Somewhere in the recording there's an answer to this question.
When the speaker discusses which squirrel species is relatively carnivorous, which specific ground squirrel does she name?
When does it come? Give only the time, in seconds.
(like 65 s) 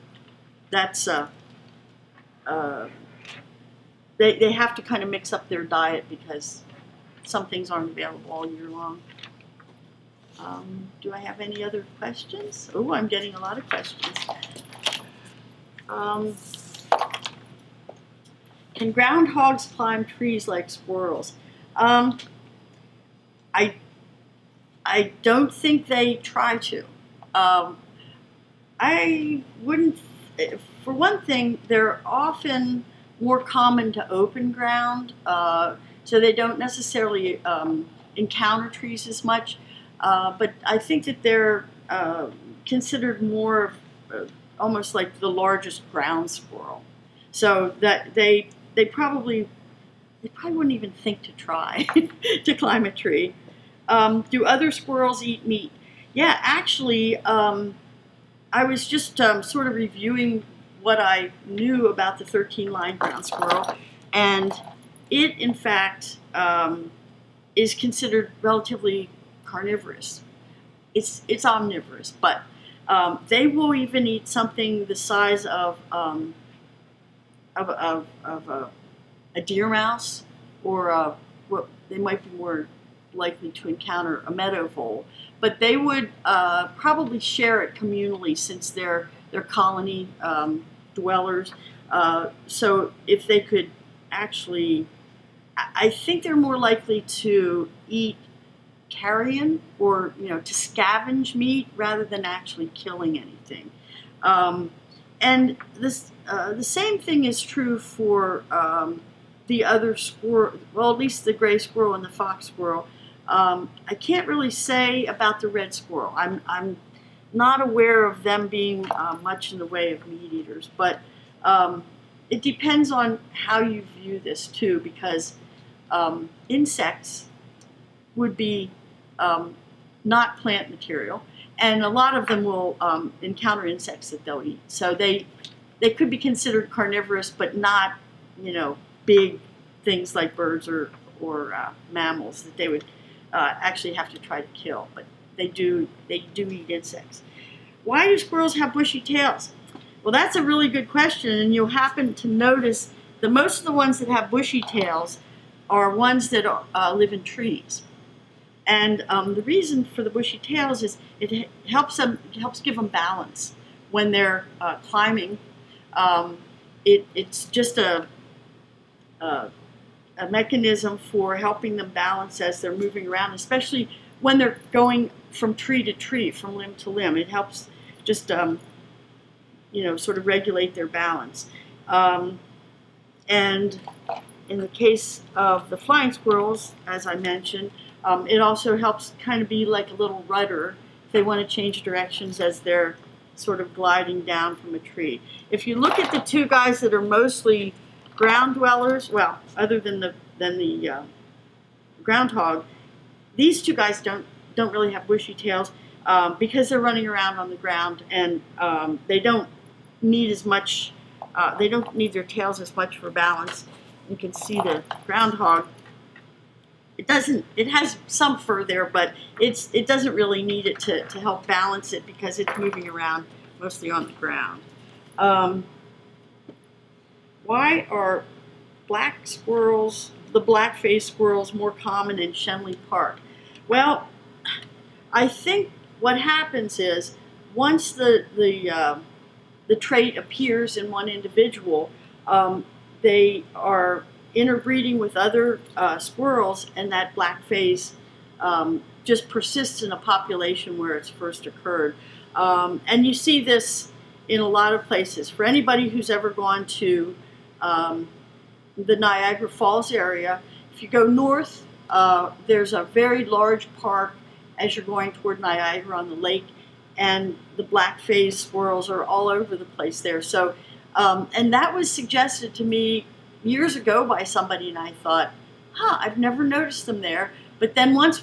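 62 s.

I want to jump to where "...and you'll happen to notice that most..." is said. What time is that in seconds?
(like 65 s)
151 s.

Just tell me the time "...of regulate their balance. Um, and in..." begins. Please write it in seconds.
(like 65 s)
180 s.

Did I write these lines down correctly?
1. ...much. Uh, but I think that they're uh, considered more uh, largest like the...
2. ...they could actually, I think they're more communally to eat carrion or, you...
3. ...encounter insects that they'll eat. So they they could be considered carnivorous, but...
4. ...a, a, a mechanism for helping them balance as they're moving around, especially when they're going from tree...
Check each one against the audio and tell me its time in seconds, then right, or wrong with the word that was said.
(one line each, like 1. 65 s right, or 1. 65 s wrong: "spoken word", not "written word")
1. 39 s wrong: "almost", not "largest"
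2. 93 s wrong: "likely", not "communally"
3. 133 s right
4. 167 s right.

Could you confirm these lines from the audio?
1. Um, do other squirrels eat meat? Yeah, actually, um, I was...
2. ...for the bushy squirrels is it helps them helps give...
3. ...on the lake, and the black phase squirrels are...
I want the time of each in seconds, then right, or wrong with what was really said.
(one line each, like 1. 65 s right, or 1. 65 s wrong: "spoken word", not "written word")
1. 53 s right
2. 159 s wrong: "tails", not "squirrels"
3. 265 s right.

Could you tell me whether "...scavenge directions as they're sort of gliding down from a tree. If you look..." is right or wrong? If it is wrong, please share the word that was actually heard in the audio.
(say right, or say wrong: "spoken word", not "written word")
wrong: "change", not "scavenge".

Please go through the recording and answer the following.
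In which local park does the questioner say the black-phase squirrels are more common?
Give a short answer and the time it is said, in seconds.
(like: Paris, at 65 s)
Schenley Park, at 232 s.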